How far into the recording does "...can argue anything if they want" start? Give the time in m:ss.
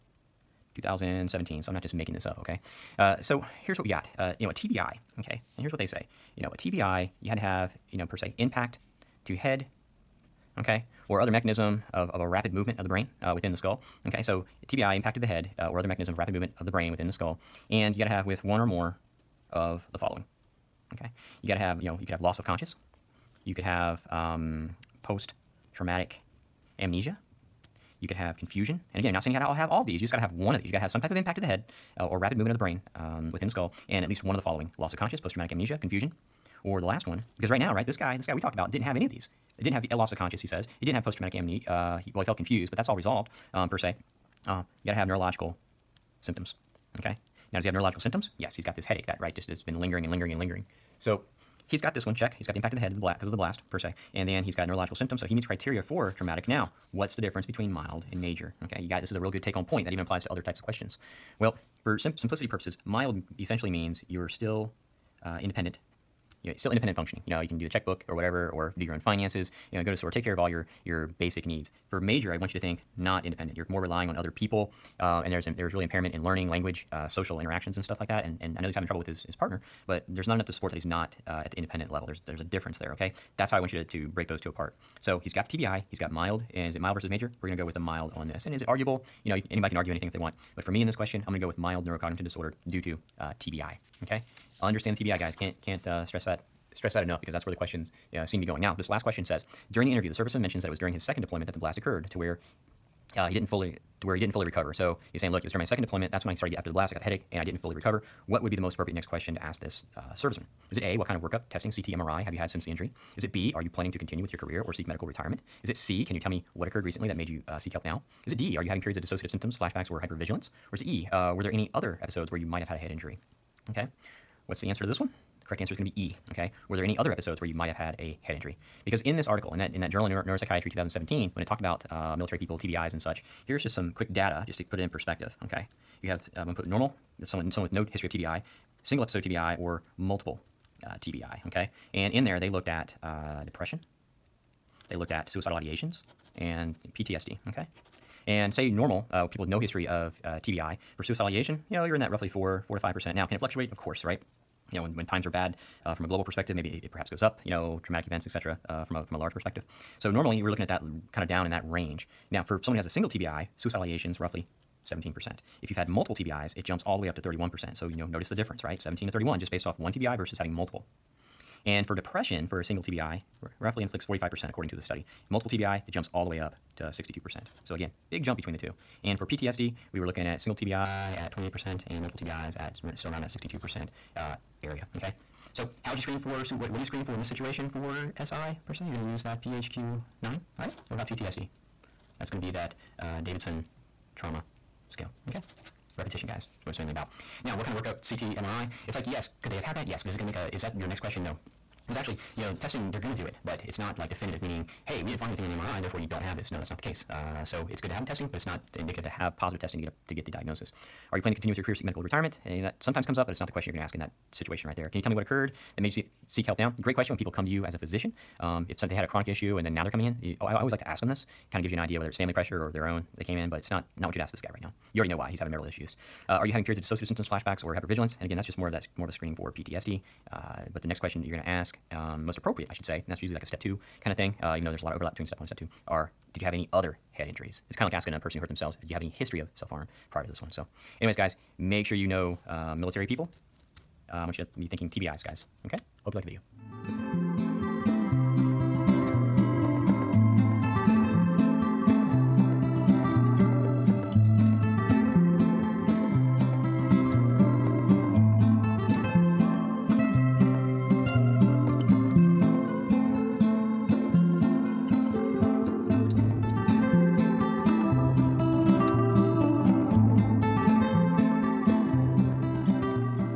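1:29.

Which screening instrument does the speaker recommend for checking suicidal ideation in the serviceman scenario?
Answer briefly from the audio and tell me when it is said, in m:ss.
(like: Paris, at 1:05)
PHQ-9, at 3:09.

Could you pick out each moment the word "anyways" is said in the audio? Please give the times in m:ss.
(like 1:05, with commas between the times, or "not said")
4:01.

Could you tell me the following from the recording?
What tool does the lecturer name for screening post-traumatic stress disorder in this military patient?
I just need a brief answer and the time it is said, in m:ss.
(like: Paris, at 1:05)
Davidson trauma scale, at 3:13.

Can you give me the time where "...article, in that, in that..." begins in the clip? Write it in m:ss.
2:09.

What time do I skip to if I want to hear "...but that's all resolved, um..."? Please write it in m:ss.
0:42.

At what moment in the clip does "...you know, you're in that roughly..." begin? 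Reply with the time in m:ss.
2:31.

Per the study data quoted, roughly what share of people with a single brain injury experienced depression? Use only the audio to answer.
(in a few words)
45%.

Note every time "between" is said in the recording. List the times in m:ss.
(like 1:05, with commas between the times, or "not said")
0:57, 2:58, 3:55.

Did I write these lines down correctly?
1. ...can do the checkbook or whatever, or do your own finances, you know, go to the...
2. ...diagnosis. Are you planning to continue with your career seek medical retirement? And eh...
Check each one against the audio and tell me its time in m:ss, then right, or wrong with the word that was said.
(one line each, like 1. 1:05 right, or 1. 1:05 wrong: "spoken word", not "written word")
1. 1:07 right
2. 3:30 right.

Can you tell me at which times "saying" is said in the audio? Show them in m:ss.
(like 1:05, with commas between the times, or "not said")
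0:29, 1:45.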